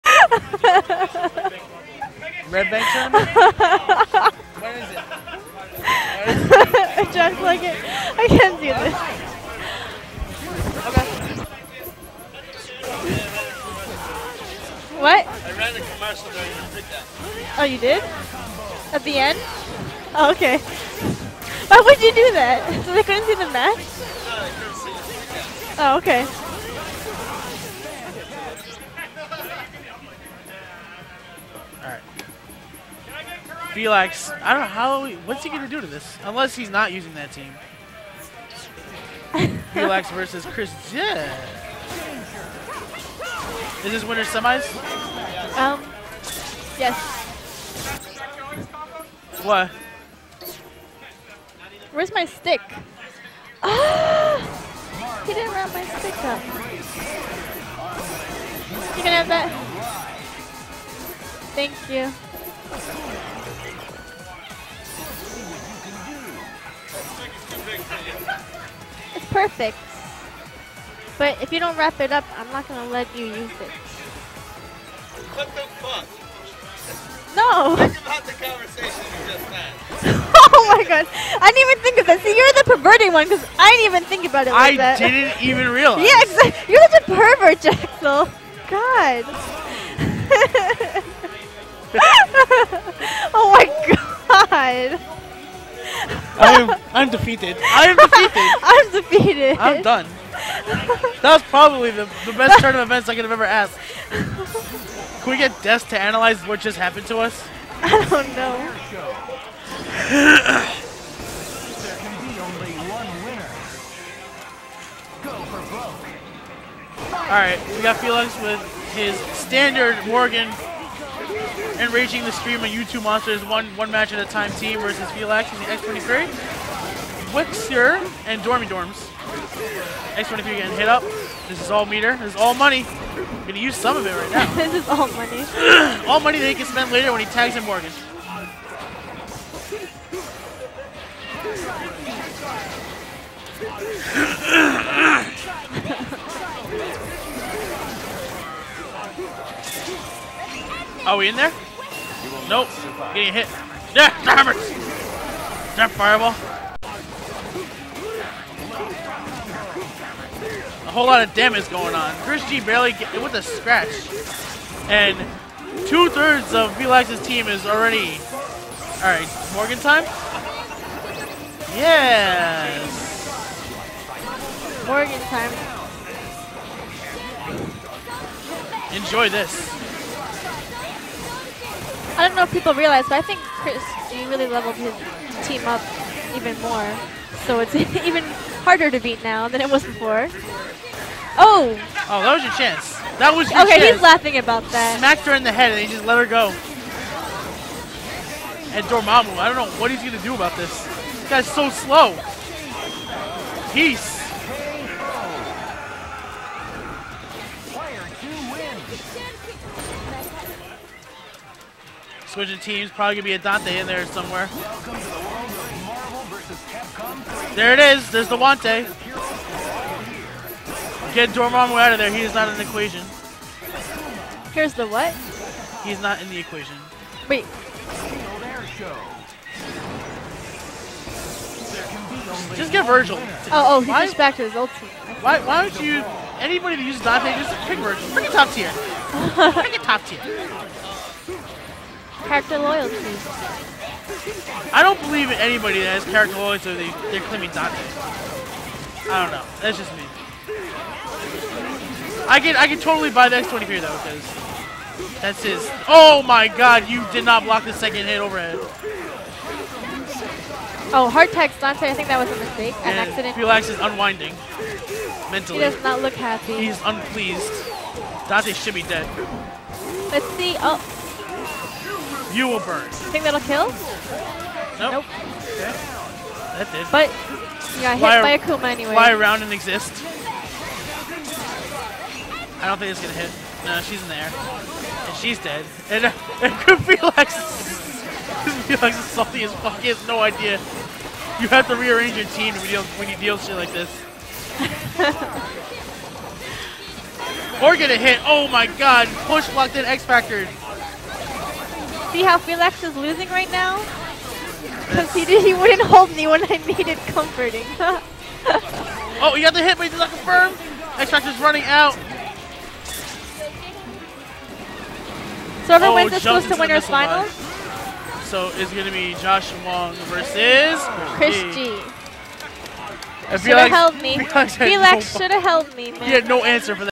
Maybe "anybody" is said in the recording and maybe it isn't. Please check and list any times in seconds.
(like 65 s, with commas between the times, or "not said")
236 s, 245 s.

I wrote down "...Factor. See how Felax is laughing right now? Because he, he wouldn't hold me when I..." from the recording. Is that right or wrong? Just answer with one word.
wrong.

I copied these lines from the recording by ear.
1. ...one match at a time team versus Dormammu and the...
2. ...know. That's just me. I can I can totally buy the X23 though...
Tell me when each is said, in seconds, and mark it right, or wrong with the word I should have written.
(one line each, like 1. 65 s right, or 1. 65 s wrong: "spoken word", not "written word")
1. 123 s wrong: "Felix", not "Dormammu"
2. 249 s right.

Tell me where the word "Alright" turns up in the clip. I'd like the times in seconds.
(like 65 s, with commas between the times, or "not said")
117 s, 169 s.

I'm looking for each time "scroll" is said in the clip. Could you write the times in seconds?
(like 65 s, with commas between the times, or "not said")
not said.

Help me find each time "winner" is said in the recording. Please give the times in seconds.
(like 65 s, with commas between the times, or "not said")
44 s, 316 s.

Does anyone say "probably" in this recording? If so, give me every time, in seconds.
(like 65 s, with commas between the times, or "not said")
101 s, 212 s.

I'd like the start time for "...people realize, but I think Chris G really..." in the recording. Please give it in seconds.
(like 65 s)
182 s.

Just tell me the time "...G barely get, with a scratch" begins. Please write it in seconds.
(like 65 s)
162 s.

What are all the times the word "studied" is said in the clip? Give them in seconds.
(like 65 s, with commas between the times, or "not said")
not said.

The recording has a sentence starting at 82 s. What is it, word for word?
See, you're the perverted one because I didn't even think about it like I that.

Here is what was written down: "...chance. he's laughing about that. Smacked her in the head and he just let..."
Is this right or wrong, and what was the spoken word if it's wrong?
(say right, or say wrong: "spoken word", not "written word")
right.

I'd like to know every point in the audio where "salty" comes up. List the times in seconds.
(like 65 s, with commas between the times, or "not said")
289 s.